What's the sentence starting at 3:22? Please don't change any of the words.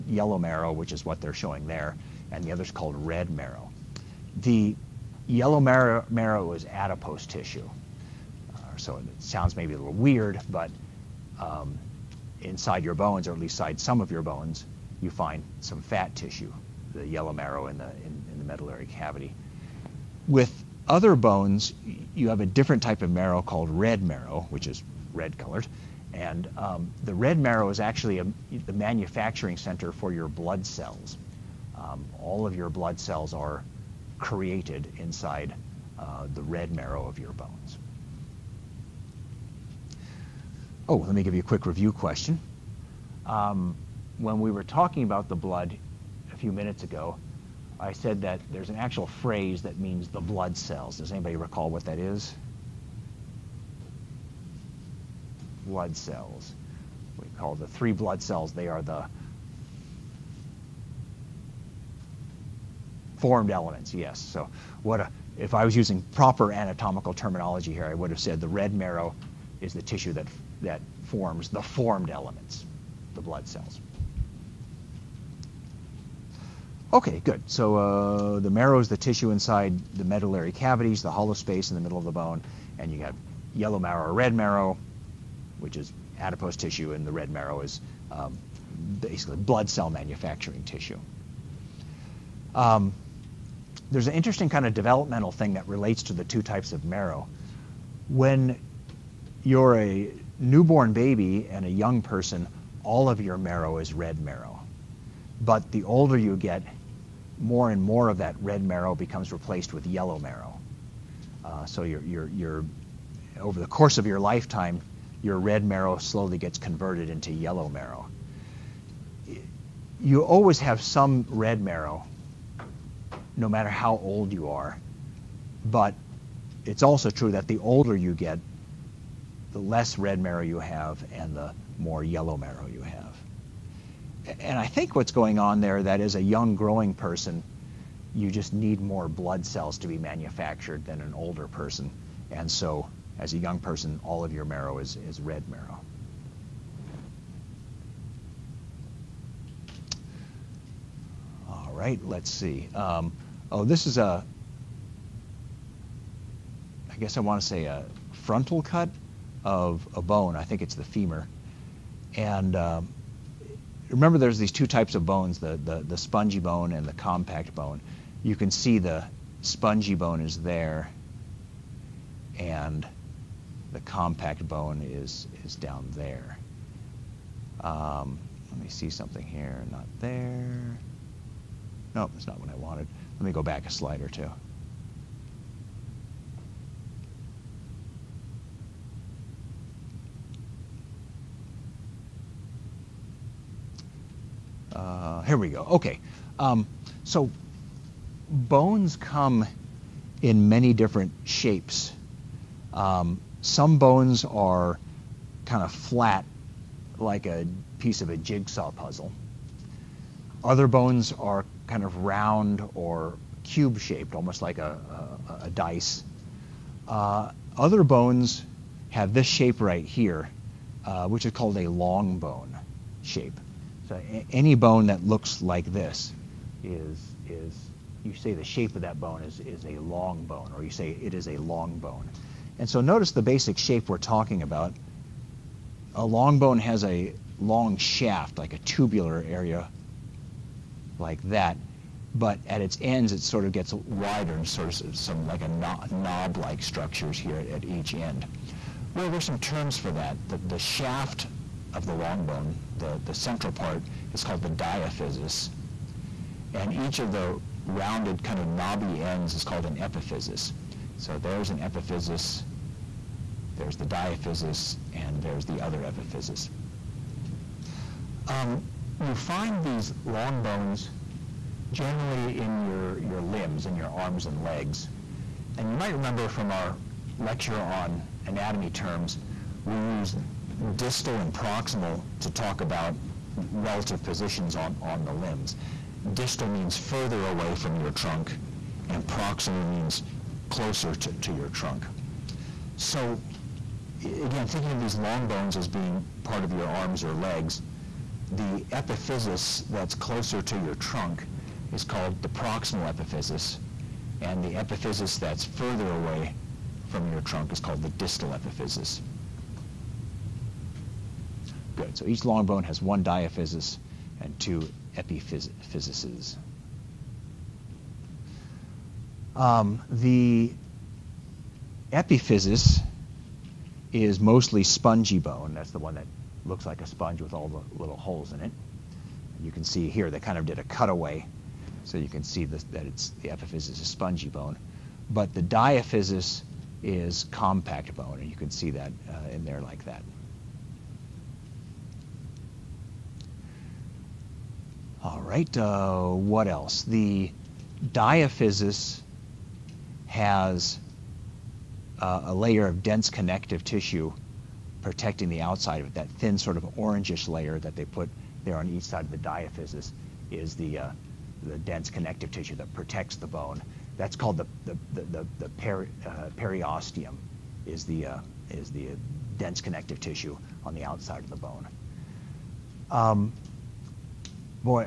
Um, some bones are kind of flat, like a piece of a jigsaw puzzle.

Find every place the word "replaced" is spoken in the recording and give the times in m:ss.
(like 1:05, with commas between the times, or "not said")
1:49.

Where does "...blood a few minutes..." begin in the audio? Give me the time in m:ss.
0:45.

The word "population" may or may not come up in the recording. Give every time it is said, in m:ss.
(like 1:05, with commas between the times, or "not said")
not said.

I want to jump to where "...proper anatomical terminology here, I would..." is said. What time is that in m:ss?
1:06.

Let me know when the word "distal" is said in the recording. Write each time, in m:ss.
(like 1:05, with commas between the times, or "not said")
4:40, 4:46, 5:07.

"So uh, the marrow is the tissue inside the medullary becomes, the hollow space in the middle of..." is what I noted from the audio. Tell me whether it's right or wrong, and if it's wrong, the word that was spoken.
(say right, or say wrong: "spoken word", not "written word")
wrong: "cavities", not "becomes".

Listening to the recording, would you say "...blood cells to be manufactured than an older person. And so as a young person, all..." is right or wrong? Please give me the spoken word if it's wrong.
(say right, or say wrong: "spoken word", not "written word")
right.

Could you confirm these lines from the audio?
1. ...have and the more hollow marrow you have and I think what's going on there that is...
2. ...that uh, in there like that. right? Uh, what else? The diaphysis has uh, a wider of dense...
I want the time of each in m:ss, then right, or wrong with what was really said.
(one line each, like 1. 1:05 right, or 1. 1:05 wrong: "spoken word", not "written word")
1. 2:10 wrong: "yellow", not "hollow"
2. 5:38 wrong: "layer", not "wider".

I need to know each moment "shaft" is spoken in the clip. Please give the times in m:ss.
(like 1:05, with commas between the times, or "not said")
3:57, 4:10.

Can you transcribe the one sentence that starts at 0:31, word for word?
Um, all of your blood cells are created inside uh, the red marrow of your bones.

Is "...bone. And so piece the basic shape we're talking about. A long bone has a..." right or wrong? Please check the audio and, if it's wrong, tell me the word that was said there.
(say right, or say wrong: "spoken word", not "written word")
wrong: "notice", not "piece".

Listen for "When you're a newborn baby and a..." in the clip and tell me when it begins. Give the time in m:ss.
1:38.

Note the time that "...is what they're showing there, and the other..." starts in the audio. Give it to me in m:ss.
0:00.